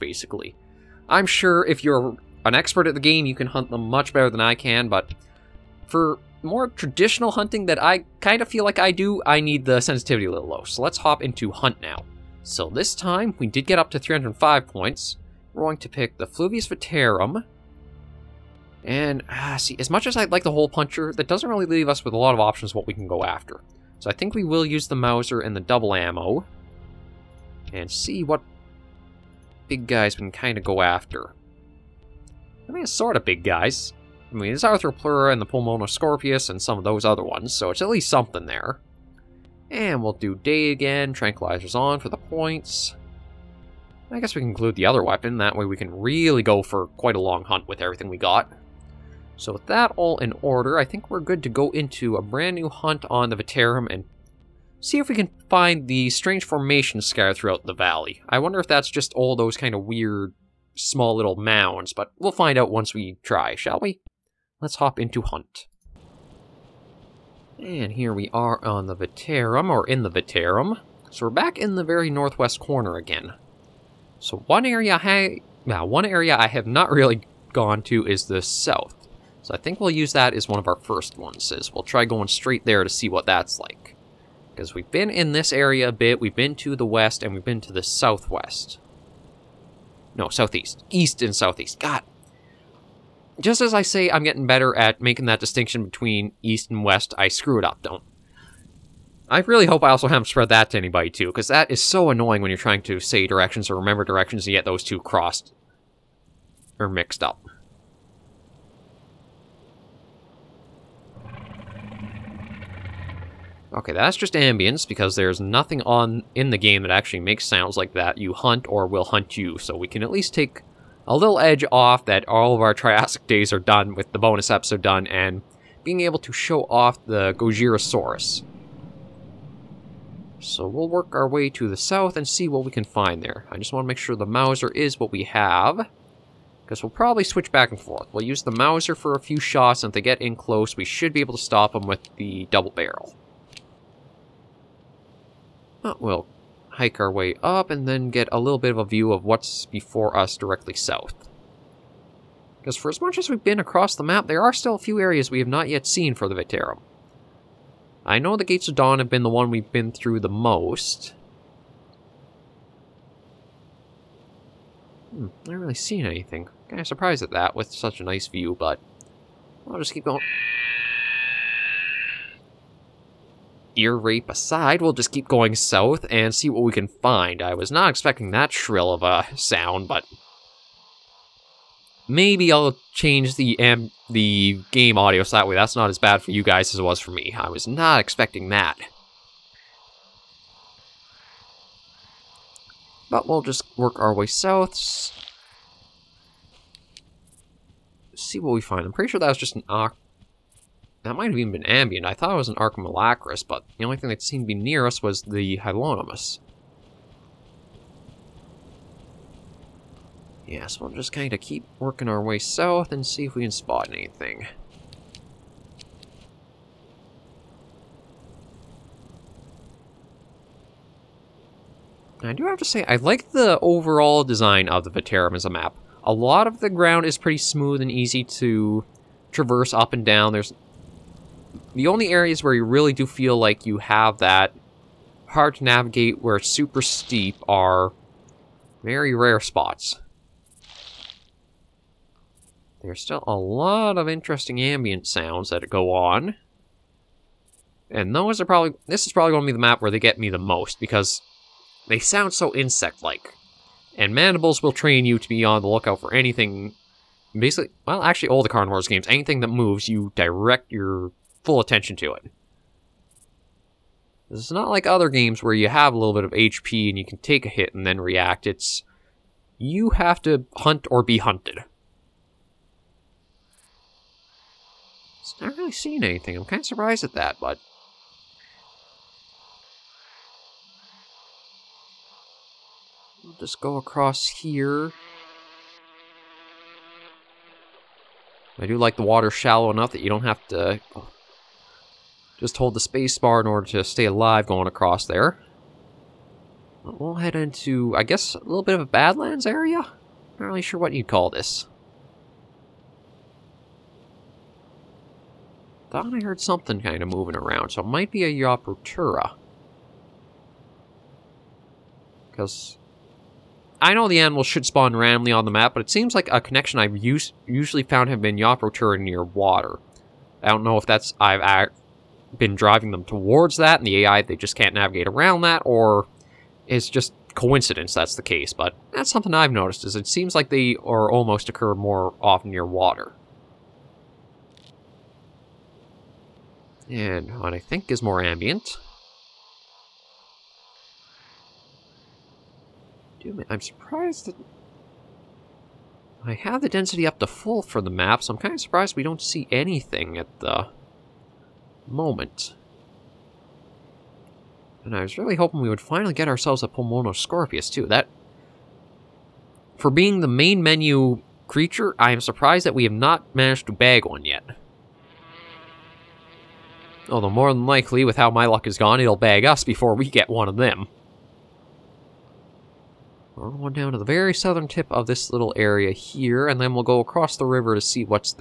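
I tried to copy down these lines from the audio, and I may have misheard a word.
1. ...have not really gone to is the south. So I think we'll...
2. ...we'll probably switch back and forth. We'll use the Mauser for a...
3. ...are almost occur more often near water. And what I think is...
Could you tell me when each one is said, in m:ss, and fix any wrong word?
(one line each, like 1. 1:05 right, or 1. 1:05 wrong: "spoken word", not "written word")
1. 1:16 right
2. 2:16 right
3. 5:30 right.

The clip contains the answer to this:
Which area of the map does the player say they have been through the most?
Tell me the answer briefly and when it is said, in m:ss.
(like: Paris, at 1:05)
Gates of Dawn, at 2:38.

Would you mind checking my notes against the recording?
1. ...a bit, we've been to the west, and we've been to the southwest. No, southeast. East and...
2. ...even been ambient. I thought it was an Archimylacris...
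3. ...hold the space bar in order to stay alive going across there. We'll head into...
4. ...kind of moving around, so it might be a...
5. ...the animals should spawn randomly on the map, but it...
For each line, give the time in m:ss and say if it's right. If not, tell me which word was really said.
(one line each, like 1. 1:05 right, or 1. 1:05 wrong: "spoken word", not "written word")
1. 1:25 right
2. 3:21 right
3. 4:52 right
4. 5:06 right
5. 5:14 right.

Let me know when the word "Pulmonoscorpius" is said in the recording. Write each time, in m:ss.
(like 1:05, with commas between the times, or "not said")
0:35, 5:56.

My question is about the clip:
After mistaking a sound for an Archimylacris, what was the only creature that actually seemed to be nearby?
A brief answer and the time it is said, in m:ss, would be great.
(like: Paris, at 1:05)
Hylonomus, at 3:25.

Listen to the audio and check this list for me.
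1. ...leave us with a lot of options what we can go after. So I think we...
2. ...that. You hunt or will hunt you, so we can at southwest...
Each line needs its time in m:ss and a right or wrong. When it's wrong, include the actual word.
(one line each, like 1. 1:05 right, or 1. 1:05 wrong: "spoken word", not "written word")
1. 0:21 right
2. 1:57 wrong: "least", not "southwest".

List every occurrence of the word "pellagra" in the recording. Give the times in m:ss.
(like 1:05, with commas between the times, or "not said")
not said.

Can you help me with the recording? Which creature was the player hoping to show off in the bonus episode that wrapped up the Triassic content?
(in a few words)
Gojirosaurus.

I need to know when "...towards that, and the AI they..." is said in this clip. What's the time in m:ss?
5:23.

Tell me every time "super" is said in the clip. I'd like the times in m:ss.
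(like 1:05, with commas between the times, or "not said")
3:56.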